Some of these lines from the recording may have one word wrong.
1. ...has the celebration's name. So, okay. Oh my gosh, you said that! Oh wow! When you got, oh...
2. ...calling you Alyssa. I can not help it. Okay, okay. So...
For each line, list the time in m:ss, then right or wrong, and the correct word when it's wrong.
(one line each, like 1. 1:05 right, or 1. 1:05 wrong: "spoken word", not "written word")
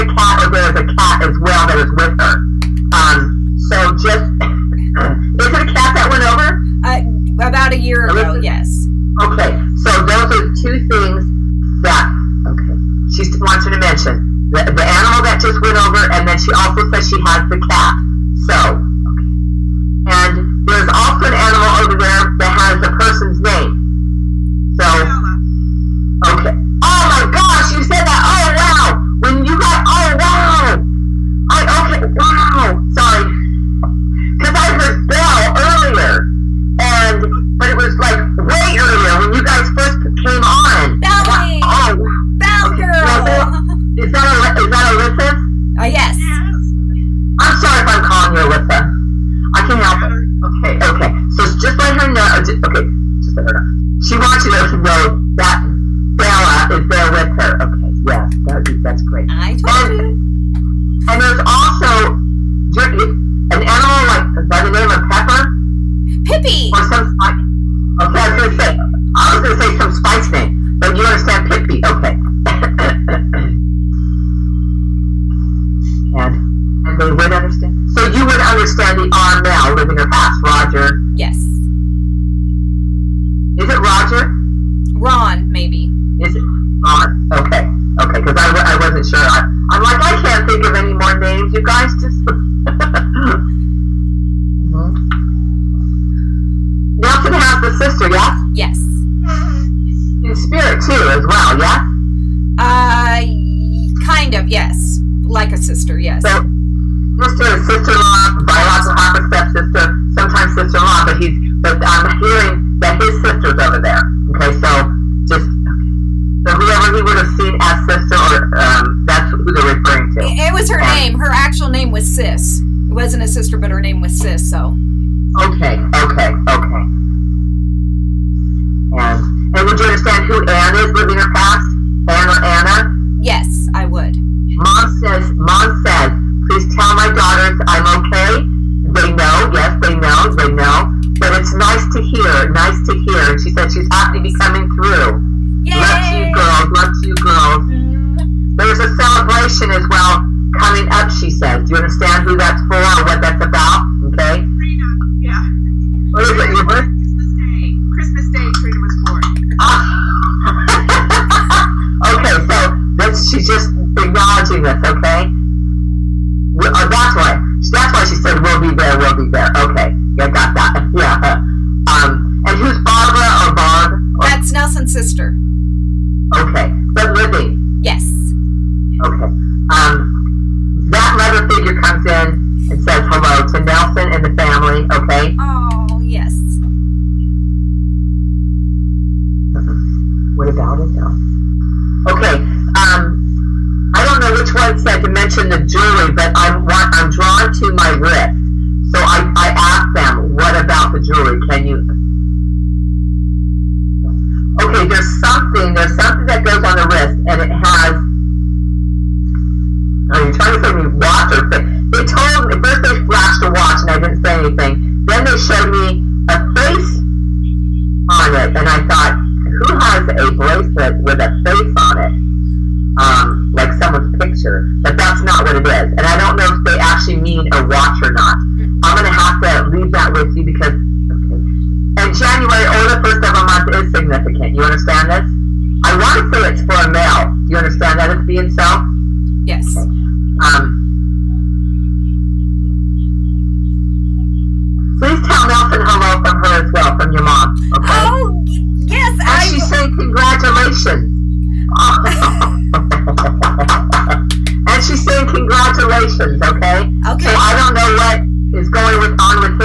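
1. 0:22 wrong: "person", not "celebration"
2. 0:48 right.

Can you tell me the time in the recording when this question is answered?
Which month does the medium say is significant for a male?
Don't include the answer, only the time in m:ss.
3:52.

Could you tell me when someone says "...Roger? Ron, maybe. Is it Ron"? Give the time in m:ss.
1:23.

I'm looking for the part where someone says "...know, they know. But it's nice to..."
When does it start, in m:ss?
2:19.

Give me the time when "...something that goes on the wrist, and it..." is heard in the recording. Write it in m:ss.
3:25.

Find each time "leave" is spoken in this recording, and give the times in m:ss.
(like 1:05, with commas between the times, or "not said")
3:49.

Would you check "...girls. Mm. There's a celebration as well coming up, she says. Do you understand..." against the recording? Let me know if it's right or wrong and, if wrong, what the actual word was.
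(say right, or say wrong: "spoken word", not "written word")
right.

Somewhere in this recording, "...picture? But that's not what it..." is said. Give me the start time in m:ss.
3:44.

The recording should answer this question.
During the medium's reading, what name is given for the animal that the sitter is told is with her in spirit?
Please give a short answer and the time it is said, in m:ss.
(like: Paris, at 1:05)
Bella, at 0:56.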